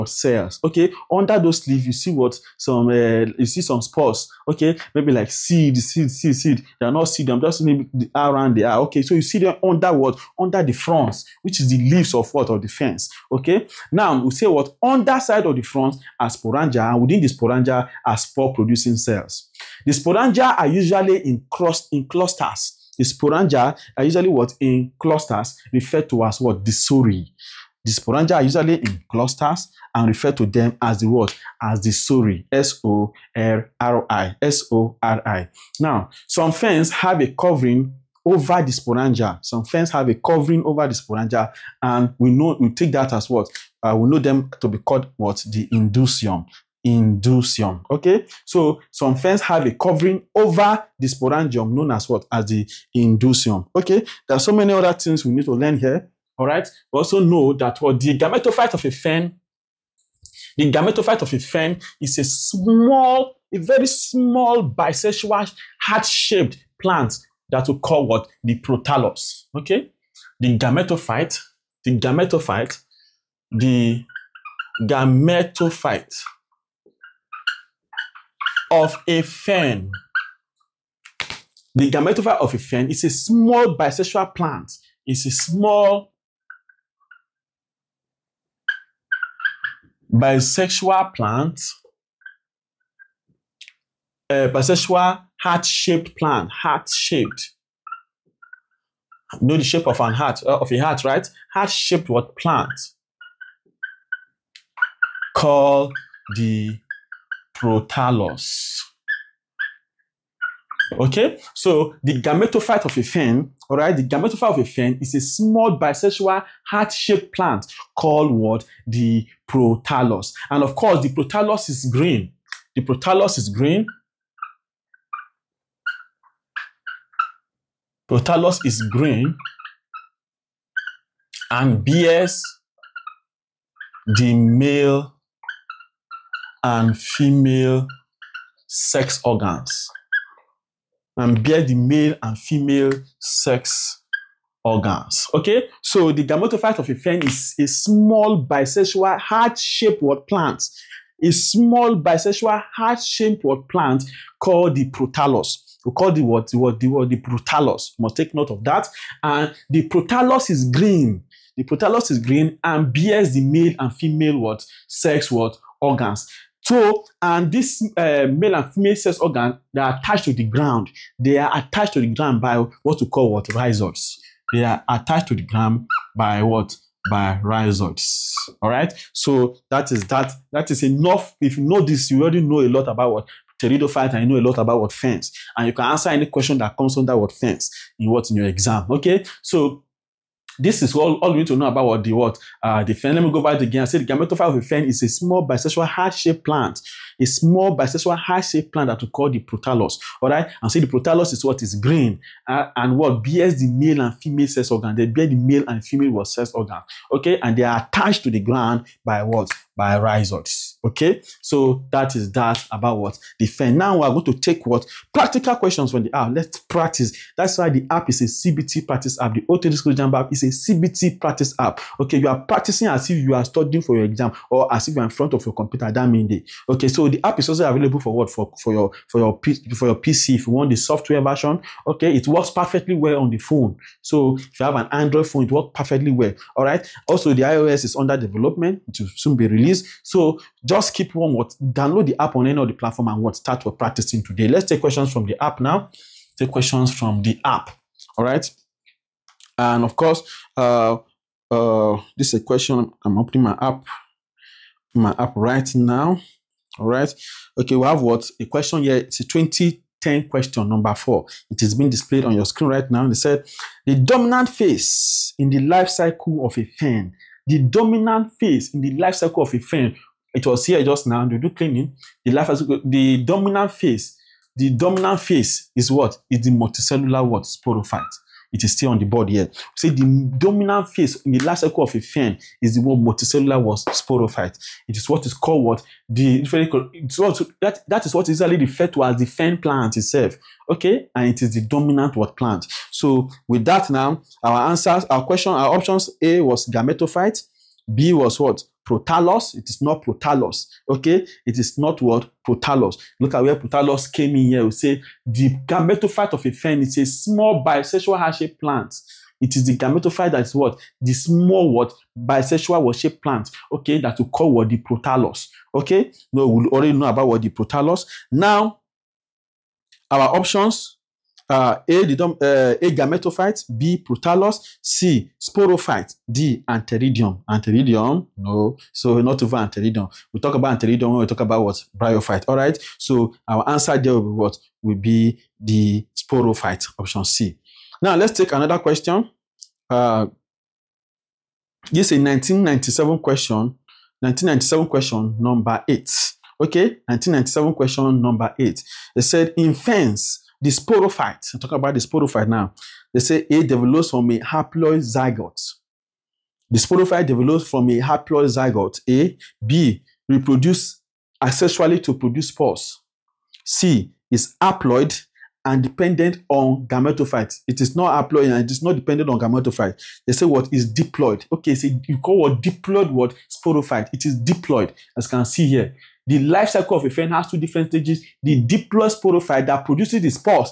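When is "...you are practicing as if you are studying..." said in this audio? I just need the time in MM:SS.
03:42.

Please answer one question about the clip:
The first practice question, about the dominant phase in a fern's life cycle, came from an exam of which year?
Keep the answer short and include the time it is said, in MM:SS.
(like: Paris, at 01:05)
2010, at 04:19.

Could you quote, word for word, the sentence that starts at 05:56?
The sporophyte develops from a haploid zygote.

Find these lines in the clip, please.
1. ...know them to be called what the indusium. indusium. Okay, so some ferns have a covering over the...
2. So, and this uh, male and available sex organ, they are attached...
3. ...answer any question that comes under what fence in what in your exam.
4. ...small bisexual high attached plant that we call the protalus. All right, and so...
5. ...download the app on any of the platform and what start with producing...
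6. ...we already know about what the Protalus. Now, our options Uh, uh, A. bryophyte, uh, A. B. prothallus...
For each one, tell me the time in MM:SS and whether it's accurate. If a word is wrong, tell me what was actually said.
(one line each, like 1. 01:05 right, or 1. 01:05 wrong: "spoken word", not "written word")
1. 00:44 right
2. 02:46 wrong: "female", not "available"
3. 03:05 right
4. 03:17 wrong: "shaped", not "attached"
5. 04:01 wrong: "practicing", not "producing"
6. 05:16 wrong: "gametophyte", not "bryophyte".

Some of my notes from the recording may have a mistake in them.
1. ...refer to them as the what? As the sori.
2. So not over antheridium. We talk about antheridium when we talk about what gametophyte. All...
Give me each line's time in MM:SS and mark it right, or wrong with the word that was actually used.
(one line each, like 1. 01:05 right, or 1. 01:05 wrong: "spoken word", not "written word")
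1. 00:30 right
2. 05:28 wrong: "bryophyte", not "gametophyte".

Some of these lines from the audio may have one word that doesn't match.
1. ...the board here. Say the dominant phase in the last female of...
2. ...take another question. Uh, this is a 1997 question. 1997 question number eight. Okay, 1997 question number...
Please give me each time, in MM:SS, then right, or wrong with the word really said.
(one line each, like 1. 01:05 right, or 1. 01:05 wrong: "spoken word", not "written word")
1. 04:38 wrong: "cycle", not "female"
2. 05:38 right.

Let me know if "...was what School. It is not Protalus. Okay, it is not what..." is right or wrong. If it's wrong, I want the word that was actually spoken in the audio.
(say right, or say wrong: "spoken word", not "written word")
wrong: "Protalus", not "School".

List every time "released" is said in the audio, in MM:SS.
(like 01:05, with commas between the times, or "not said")
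03:59.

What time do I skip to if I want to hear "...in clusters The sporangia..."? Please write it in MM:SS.
00:21.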